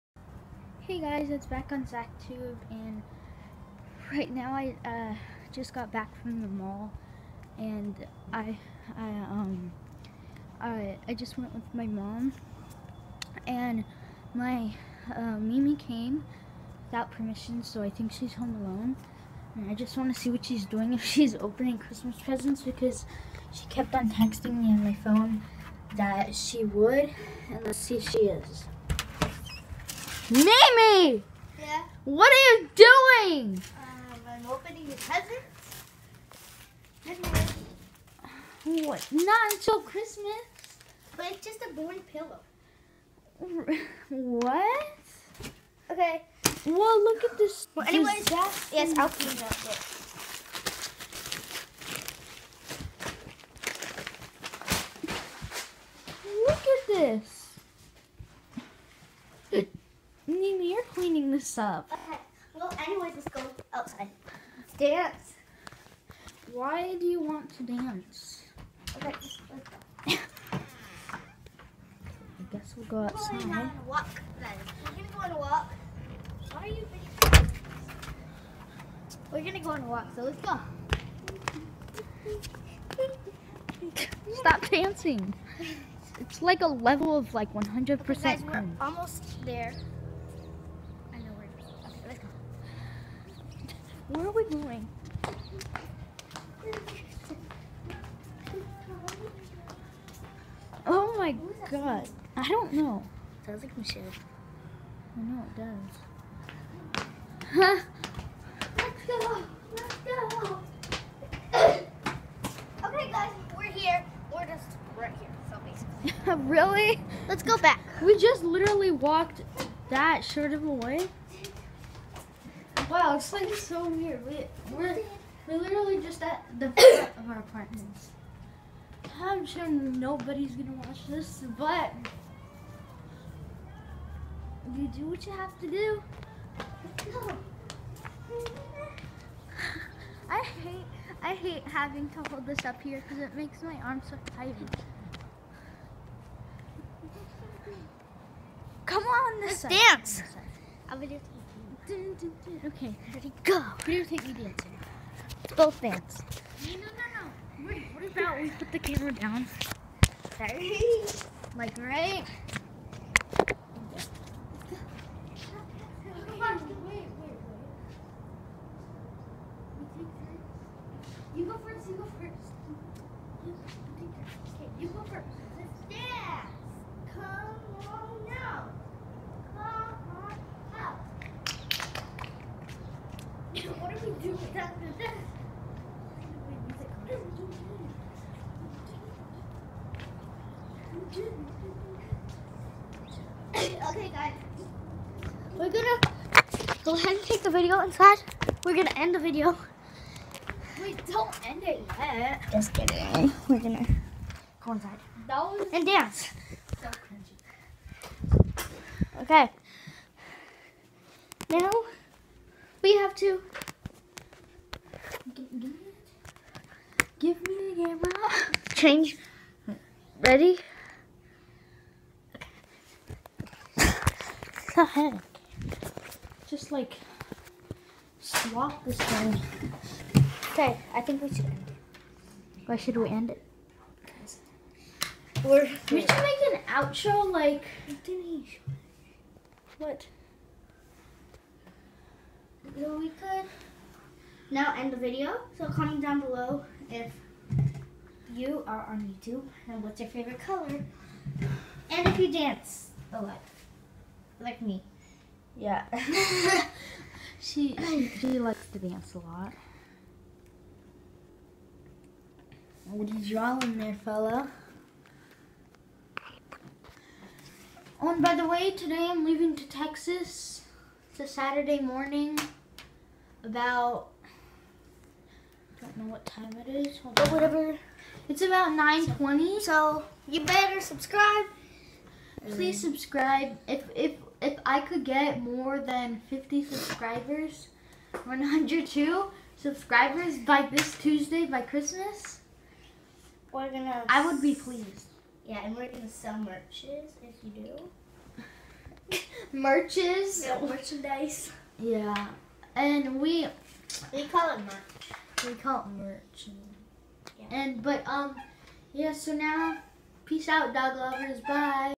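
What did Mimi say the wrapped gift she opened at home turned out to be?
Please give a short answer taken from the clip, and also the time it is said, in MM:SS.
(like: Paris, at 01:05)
a boring pillow, at 00:41.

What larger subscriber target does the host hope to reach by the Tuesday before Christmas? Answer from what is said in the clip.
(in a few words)
102.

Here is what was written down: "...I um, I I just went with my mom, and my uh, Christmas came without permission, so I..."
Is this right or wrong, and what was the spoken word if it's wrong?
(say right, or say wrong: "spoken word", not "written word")
wrong: "Mimi", not "Christmas".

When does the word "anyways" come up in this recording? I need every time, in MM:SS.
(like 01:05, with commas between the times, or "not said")
00:47, 01:02.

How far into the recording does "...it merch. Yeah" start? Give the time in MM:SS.
05:05.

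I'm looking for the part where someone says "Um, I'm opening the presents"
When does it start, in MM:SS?
00:33.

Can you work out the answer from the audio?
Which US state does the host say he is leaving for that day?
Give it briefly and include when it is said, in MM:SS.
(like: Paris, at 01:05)
Texas, at 04:29.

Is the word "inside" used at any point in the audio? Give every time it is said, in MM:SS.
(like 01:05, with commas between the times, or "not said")
03:17, 03:24.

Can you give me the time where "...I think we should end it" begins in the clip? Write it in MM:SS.
03:50.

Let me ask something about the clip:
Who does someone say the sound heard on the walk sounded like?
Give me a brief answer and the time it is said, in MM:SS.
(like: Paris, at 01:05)
Michelle, at 01:43.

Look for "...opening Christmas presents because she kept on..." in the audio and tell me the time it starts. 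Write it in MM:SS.
00:21.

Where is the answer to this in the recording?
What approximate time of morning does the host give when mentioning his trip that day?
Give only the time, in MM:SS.
04:38.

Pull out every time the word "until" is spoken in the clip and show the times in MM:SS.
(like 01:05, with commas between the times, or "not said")
00:39.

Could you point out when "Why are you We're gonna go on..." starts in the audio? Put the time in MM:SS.
01:16.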